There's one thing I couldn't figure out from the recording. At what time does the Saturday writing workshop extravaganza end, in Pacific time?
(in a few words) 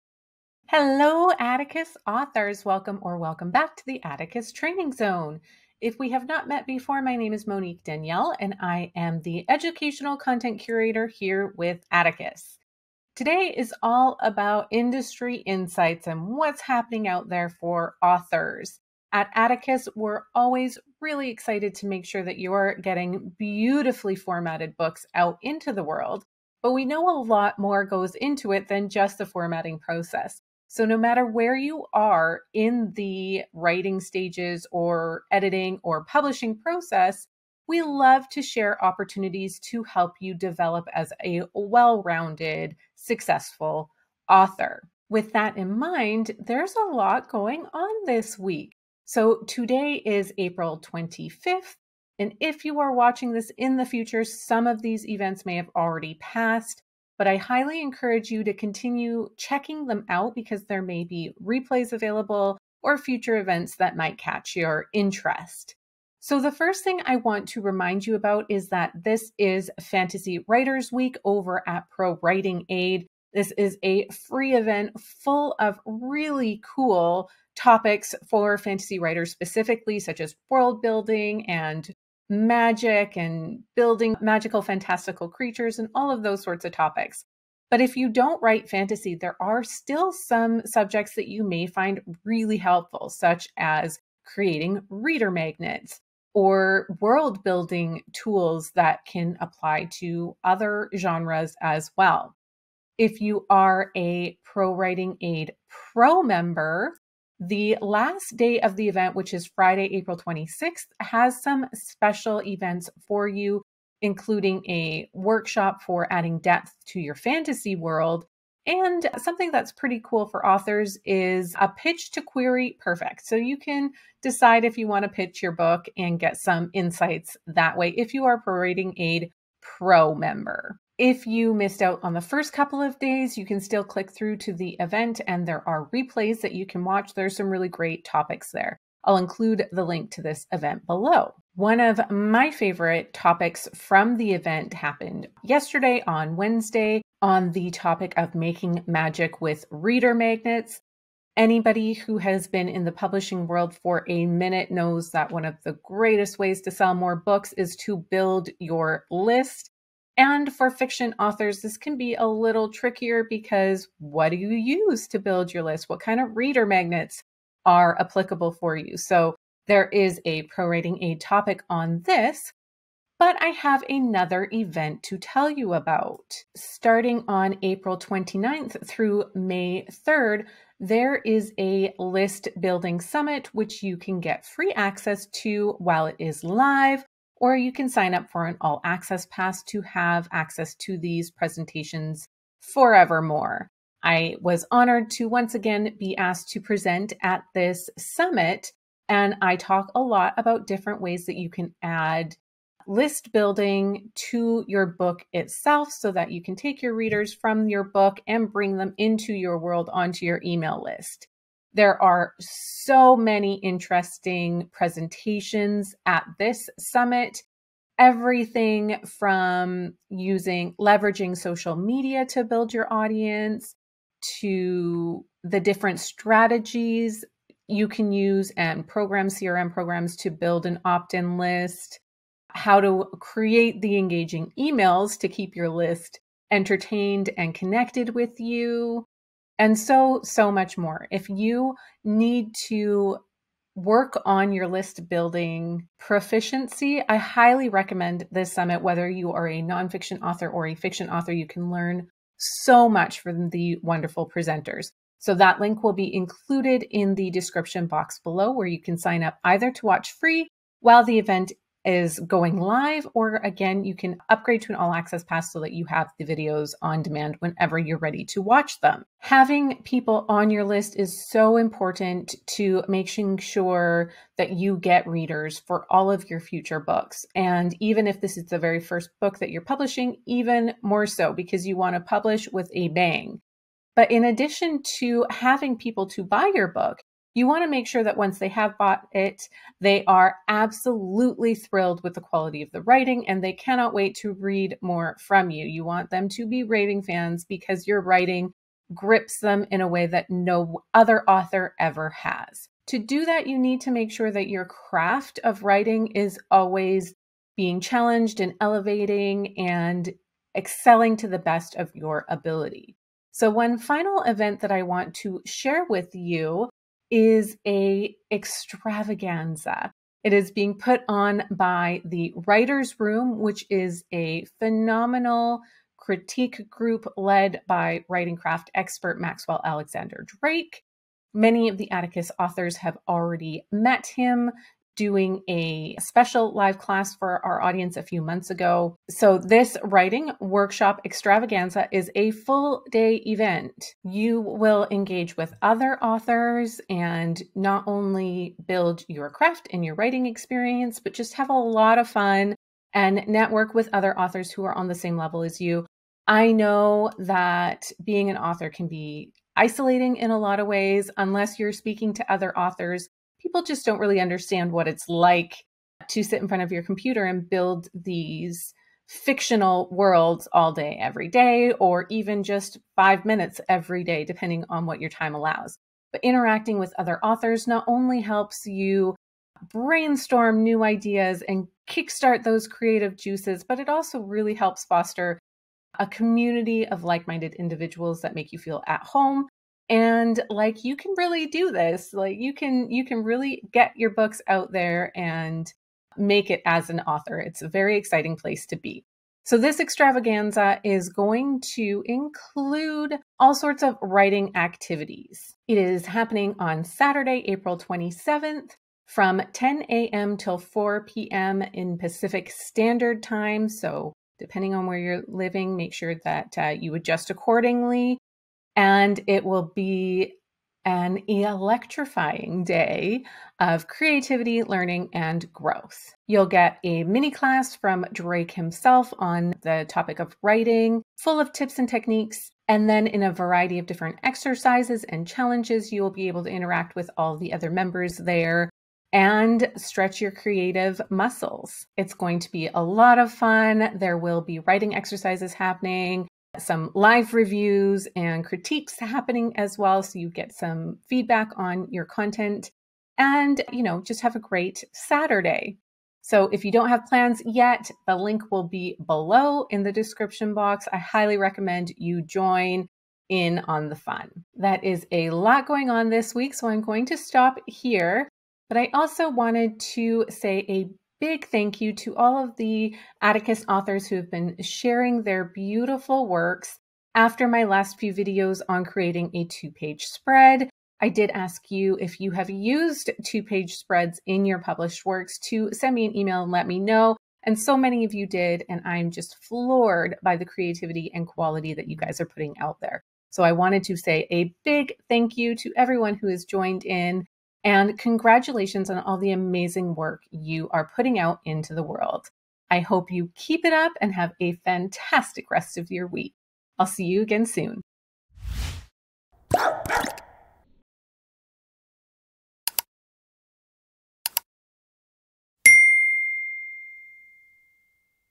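4 p.m.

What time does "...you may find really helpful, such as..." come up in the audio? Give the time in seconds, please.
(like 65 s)
91 s.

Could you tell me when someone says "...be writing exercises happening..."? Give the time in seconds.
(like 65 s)
444 s.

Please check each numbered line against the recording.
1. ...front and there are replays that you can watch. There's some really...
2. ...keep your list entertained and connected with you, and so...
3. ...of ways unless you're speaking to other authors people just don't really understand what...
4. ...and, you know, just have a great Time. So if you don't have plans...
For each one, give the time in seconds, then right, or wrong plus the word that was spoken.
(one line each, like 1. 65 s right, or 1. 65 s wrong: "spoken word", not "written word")
1. 134 s wrong: "event", not "front"
2. 235 s right
3. 360 s right
4. 453 s wrong: "Saturday", not "Time".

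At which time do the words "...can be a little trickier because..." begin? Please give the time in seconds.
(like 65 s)
161 s.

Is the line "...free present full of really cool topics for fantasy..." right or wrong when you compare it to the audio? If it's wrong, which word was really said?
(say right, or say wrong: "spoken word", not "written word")
wrong: "event", not "present".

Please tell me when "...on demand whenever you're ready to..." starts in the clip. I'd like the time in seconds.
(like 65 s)
266 s.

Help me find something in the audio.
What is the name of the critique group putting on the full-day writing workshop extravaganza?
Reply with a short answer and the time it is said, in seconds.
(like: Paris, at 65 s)
The Writers Room, at 322 s.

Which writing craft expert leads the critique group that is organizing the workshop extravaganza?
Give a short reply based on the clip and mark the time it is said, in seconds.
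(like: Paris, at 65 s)
Maxwell Alexander Drake, at 329 s.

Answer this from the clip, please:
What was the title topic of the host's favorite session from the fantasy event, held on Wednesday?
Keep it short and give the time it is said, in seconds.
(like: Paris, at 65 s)
Making magic with reader magnets, at 148 s.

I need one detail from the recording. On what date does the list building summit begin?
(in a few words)
April 29th.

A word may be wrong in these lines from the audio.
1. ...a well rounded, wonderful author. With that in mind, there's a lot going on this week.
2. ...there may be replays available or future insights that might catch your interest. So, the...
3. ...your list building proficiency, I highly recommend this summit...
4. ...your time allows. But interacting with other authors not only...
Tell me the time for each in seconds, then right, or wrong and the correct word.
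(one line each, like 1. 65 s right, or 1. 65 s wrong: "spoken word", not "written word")
1. 41 s wrong: "successful", not "wonderful"
2. 60 s wrong: "events", not "insights"
3. 244 s right
4. 375 s right.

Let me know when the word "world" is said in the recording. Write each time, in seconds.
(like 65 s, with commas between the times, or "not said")
25 s, 80 s, 97 s, 117 s, 153 s, 209 s, 369 s, 501 s.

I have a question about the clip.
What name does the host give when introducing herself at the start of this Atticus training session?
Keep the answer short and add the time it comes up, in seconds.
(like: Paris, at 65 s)
Monique Danielle, at 7 s.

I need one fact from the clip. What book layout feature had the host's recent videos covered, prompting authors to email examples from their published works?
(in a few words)
Two page spread.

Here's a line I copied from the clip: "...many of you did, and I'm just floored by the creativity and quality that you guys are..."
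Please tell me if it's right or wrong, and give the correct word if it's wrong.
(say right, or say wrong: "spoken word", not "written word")
right.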